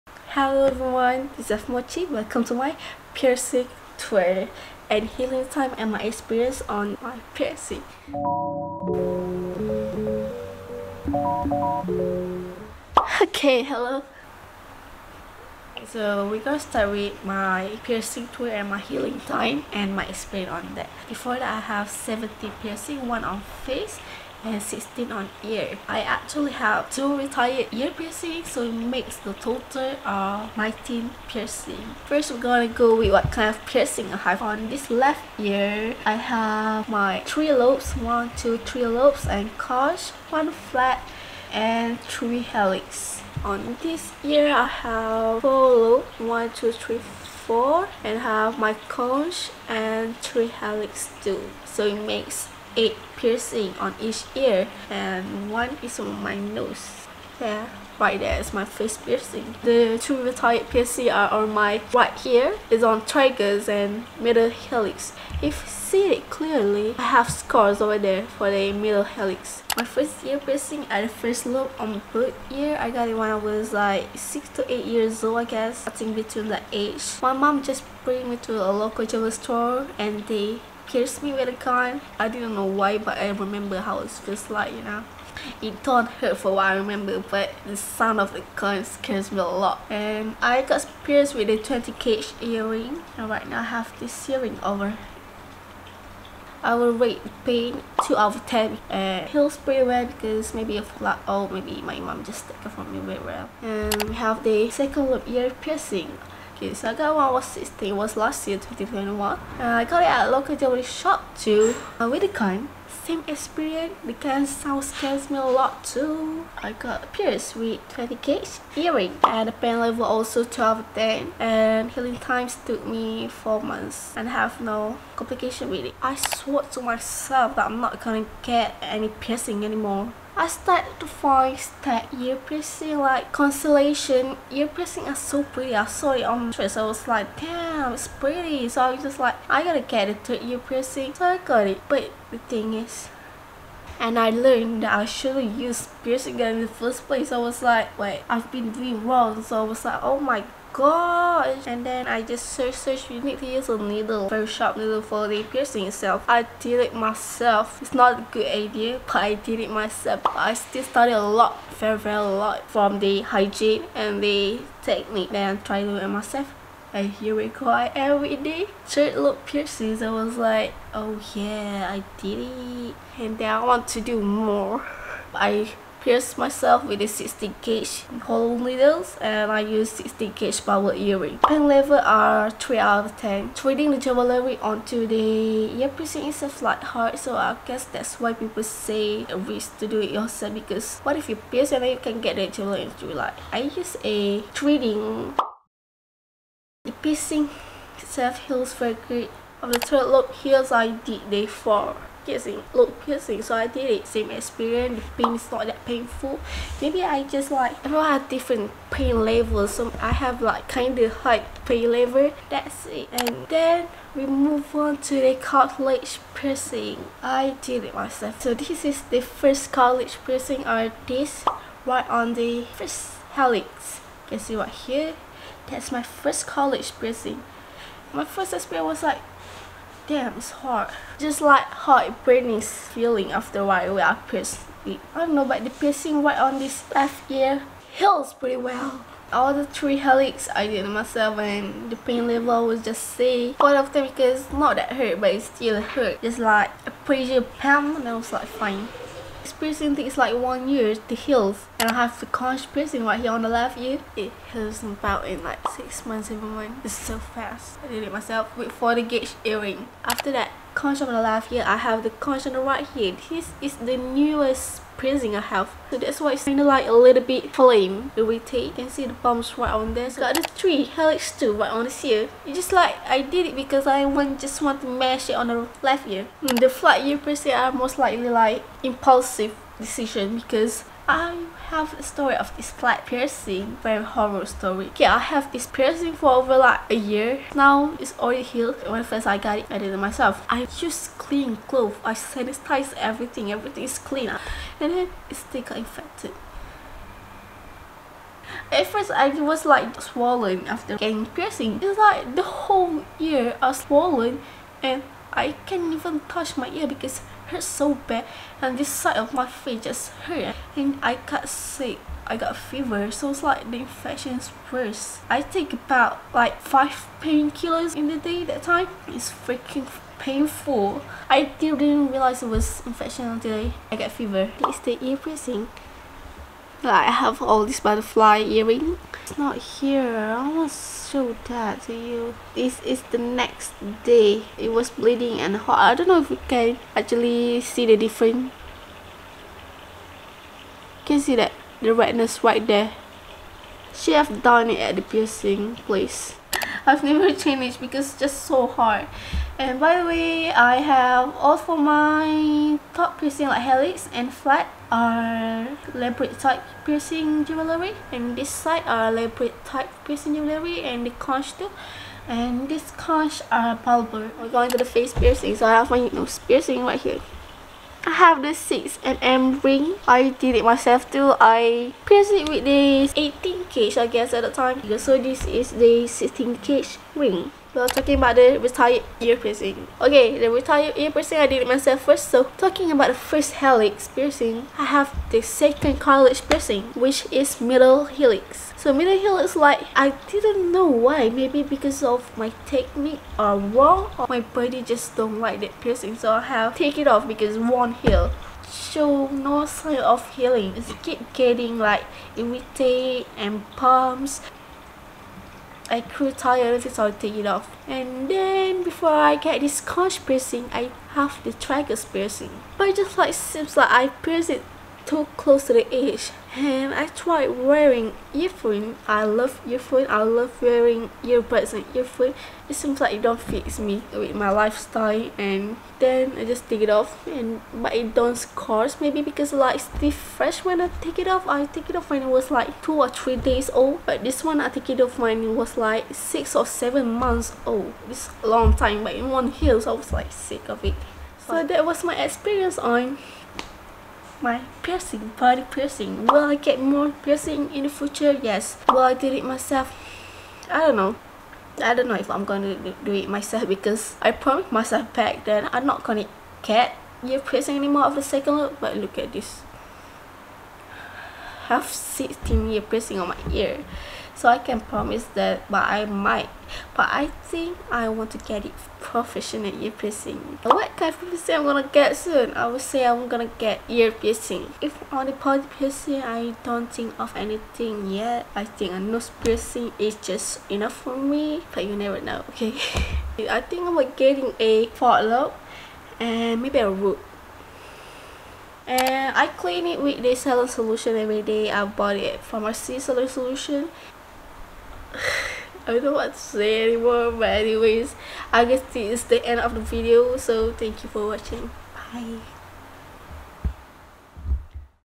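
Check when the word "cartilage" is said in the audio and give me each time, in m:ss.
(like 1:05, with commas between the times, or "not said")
3:35, 3:39, 6:26.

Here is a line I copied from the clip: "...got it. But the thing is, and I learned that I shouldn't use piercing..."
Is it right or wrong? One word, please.
right.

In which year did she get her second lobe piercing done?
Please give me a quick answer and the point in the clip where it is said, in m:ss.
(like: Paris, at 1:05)
2021, at 1:48.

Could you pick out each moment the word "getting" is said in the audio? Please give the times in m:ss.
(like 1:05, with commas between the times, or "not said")
5:00, 6:41, 8:04.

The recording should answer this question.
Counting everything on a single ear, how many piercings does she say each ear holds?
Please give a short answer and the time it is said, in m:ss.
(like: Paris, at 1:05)
8, at 0:52.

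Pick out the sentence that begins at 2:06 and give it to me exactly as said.
I swore to myself that I'm not gonna get any piercing anymore.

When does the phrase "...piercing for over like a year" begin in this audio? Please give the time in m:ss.
4:45.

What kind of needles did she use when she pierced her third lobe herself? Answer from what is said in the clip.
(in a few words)
16 gauge hollow needles.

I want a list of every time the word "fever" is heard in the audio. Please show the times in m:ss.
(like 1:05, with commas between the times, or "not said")
5:12, 5:24.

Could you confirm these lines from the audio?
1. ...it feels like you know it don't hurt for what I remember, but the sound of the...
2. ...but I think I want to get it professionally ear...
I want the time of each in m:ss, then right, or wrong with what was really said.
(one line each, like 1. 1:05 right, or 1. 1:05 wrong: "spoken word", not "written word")
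1. 1:23 right
2. 7:46 right.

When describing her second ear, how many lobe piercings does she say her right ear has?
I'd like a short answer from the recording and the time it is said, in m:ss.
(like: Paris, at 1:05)
4, at 0:45.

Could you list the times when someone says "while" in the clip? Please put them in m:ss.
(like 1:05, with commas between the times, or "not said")
3:53.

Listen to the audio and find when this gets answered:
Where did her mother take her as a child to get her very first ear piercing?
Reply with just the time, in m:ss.
1:18.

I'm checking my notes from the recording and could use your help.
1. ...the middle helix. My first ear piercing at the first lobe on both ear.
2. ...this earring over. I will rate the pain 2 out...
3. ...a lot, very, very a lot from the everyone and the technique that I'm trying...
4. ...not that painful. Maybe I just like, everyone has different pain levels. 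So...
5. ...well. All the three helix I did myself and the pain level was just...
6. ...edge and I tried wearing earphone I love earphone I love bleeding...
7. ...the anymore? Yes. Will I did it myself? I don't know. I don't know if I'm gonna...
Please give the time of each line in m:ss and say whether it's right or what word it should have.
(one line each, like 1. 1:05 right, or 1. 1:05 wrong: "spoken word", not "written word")
1. 1:08 right
2. 1:33 right
3. 2:41 wrong: "hygiene", not "everyone"
4. 3:25 right
5. 3:58 right
6. 6:55 wrong: "wearing", not "bleeding"
7. 7:27 wrong: "future", not "anymore".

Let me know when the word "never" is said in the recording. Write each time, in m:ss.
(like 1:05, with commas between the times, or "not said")
5:47, 8:01.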